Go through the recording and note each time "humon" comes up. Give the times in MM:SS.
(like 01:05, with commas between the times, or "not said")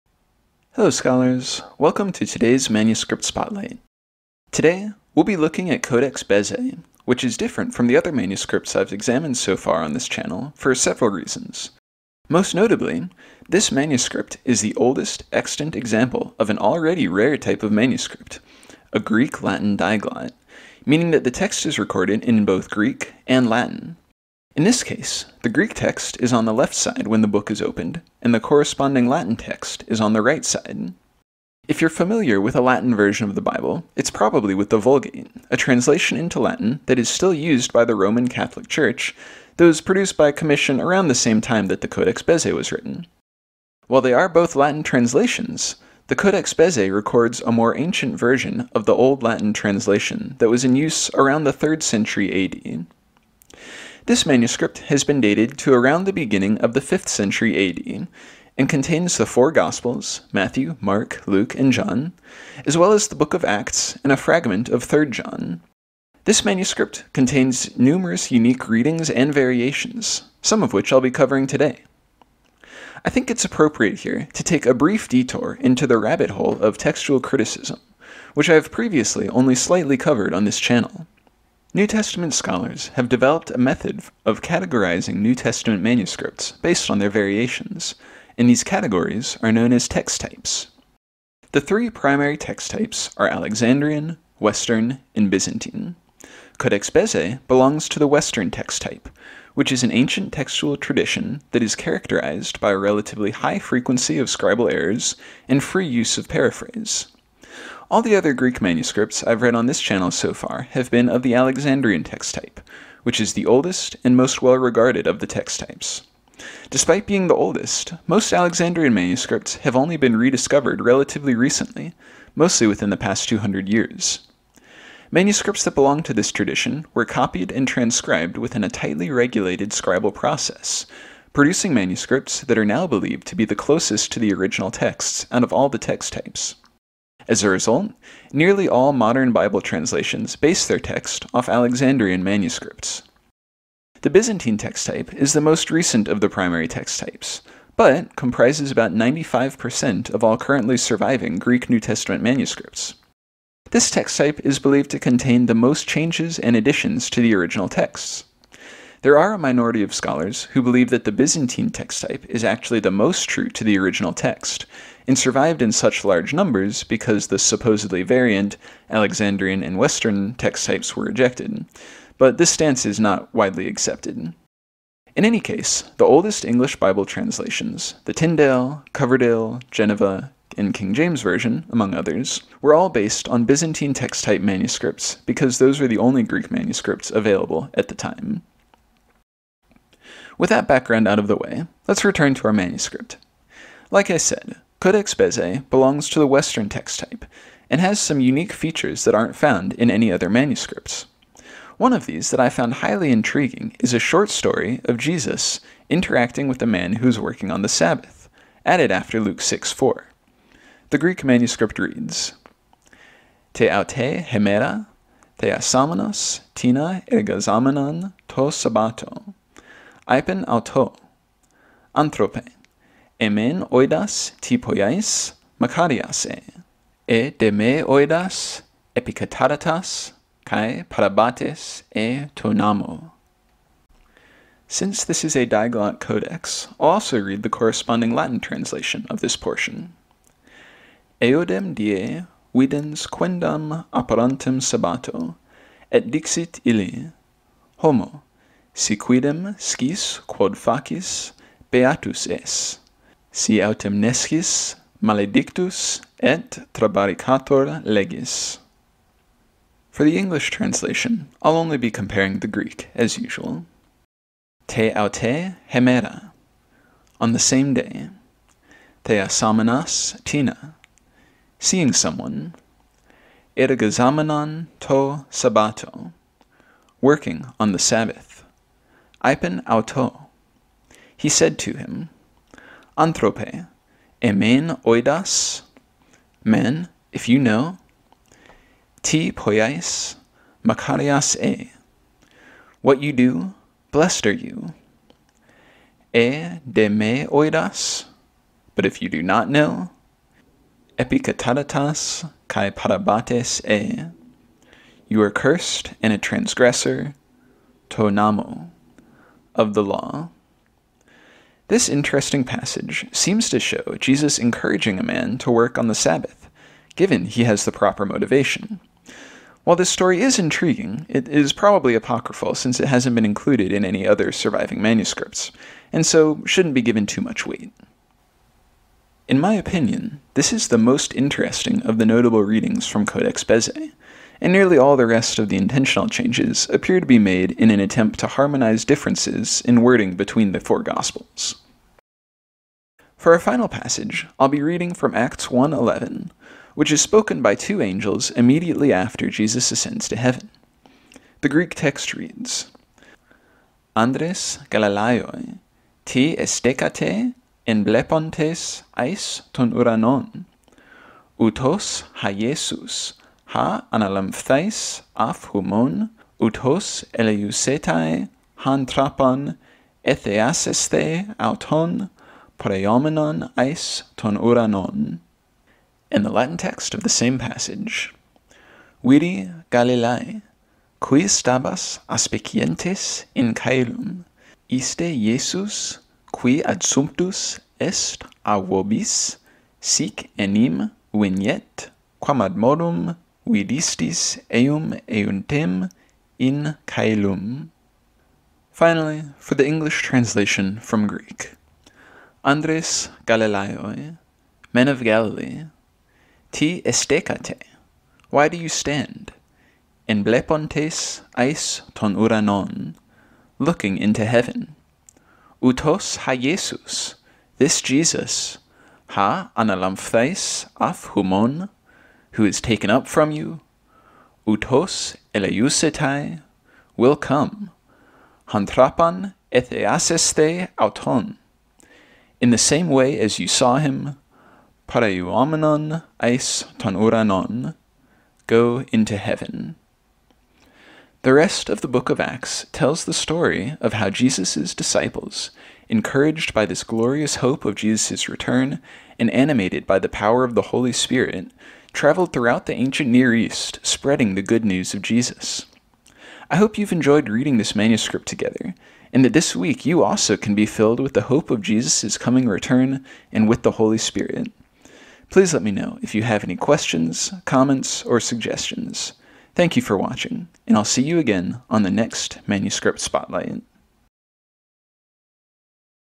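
06:05, 07:01.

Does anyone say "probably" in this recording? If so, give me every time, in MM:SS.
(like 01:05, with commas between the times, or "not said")
00:34, 05:21.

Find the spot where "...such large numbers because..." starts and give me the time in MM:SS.
02:45.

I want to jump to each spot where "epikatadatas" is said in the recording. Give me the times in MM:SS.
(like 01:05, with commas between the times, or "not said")
05:00.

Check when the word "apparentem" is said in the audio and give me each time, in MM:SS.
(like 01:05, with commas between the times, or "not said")
04:03.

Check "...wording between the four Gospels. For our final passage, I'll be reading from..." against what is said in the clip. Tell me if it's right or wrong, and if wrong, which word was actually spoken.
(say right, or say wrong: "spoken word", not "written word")
right.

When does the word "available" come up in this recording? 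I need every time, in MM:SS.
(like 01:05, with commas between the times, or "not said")
03:07.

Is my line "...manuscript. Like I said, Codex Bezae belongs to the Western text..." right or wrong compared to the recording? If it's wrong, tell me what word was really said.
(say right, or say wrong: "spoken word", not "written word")
right.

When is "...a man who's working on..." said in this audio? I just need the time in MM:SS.
03:26.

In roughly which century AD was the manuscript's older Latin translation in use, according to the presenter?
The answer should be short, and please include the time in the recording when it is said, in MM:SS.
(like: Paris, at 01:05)
3rd century, at 00:51.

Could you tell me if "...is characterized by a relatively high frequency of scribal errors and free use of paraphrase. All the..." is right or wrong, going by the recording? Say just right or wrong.
right.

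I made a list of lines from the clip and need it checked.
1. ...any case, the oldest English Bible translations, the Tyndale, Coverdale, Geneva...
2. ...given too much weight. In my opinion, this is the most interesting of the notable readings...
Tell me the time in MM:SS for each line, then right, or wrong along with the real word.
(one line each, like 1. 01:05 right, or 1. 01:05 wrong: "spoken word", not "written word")
1. 02:55 right
2. 05:26 right.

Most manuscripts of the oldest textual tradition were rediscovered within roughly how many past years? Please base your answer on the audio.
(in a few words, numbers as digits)
200 years.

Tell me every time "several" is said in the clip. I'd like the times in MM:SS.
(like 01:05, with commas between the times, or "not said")
00:10.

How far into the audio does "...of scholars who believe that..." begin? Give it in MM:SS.
02:39.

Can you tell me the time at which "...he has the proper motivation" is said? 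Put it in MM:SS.
05:17.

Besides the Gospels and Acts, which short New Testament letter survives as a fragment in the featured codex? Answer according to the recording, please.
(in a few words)
3rd John.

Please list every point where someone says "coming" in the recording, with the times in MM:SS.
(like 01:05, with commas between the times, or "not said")
07:42.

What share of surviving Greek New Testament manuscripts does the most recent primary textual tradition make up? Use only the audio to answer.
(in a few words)
95%.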